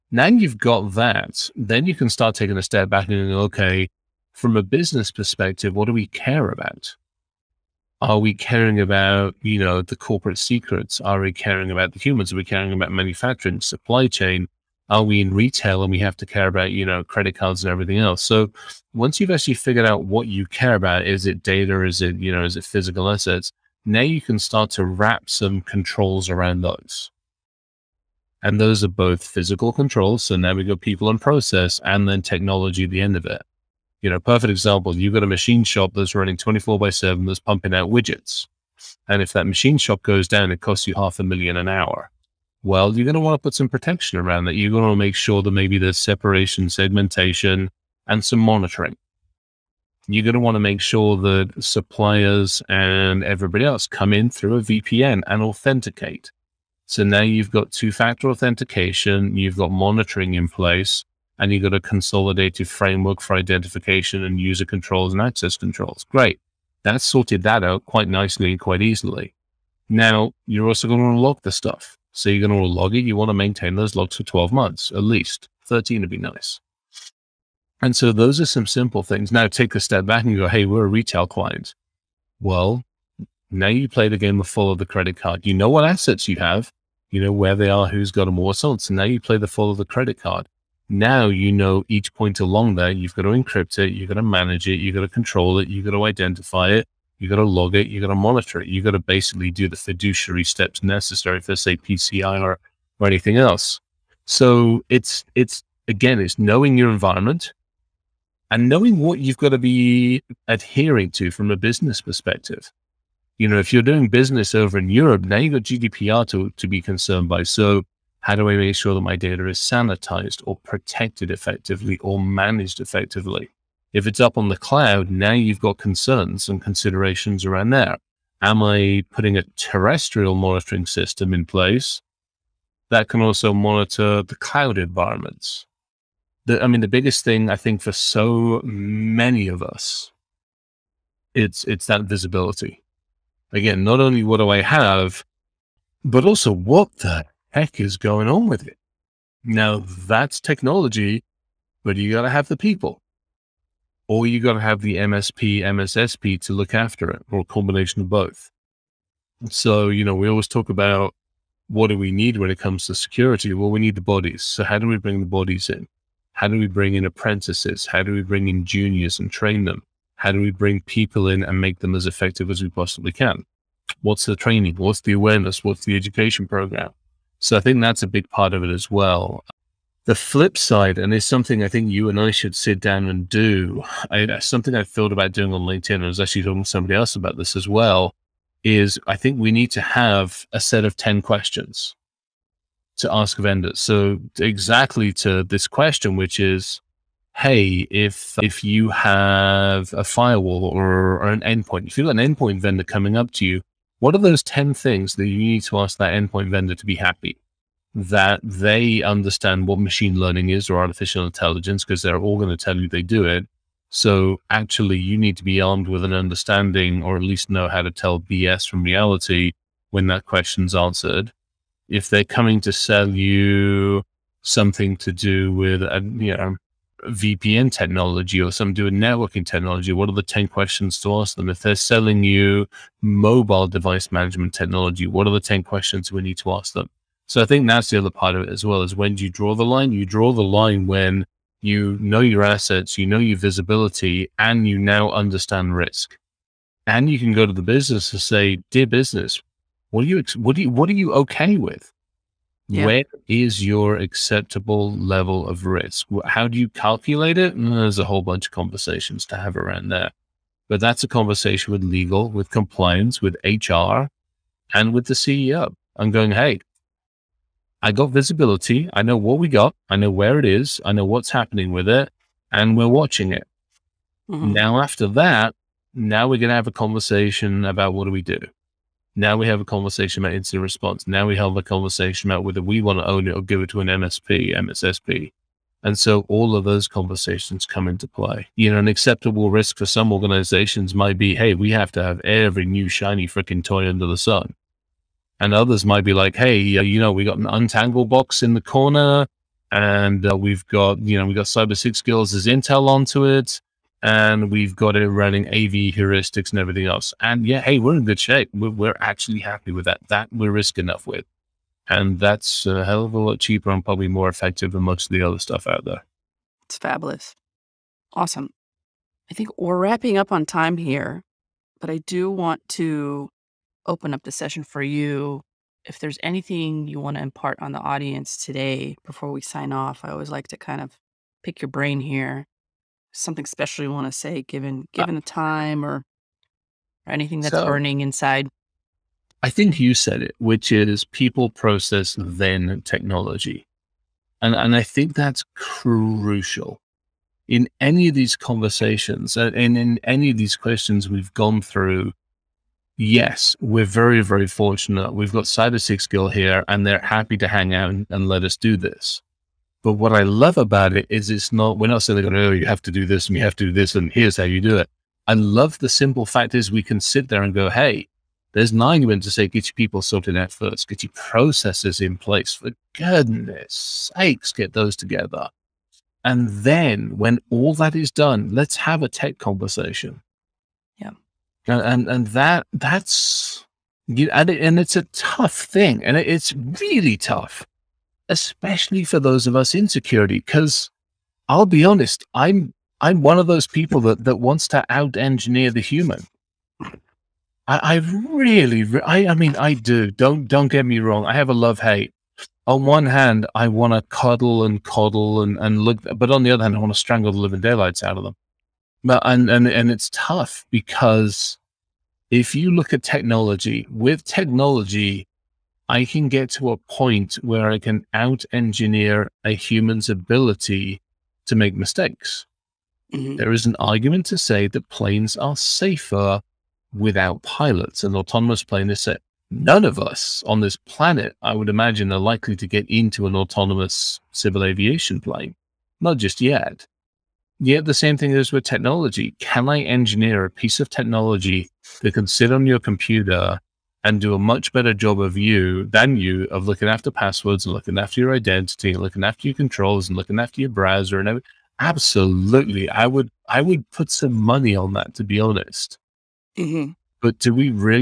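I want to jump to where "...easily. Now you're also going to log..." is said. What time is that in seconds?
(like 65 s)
68 s.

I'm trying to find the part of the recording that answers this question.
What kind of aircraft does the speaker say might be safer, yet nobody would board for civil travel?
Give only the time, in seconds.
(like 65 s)
428 s.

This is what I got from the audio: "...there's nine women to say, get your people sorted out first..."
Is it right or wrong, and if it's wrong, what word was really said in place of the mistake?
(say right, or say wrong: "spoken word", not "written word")
right.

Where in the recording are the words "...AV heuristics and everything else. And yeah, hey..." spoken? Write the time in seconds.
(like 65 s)
305 s.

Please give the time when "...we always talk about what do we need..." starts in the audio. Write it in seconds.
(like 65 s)
160 s.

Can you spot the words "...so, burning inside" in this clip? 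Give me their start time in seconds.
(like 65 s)
337 s.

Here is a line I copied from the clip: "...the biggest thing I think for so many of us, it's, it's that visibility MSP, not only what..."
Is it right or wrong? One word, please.
wrong.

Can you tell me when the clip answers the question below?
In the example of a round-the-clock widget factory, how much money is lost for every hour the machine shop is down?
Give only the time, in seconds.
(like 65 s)
40 s.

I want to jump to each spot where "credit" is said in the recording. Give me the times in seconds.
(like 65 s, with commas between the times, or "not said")
17 s, 84 s, 89 s.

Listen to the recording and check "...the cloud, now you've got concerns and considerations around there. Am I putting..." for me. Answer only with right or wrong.
right.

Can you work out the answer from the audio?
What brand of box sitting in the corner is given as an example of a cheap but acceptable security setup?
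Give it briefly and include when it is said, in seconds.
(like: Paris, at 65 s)
Untangle, at 297 s.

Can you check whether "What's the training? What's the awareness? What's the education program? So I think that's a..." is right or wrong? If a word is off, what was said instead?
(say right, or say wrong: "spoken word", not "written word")
right.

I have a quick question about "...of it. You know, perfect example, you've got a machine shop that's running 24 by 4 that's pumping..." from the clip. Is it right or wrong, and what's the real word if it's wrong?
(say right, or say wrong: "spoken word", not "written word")
wrong: "7", not "4".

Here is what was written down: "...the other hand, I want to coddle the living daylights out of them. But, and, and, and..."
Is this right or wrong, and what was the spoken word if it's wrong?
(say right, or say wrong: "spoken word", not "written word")
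wrong: "strangle", not "coddle".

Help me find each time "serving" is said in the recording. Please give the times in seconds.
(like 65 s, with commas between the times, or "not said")
not said.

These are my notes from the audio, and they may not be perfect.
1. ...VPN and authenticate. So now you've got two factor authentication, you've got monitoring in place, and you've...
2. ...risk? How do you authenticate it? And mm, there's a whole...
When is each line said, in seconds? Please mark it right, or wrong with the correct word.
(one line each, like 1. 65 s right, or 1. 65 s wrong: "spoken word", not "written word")
1. 54 s right
2. 255 s wrong: "calculate", not "authenticate".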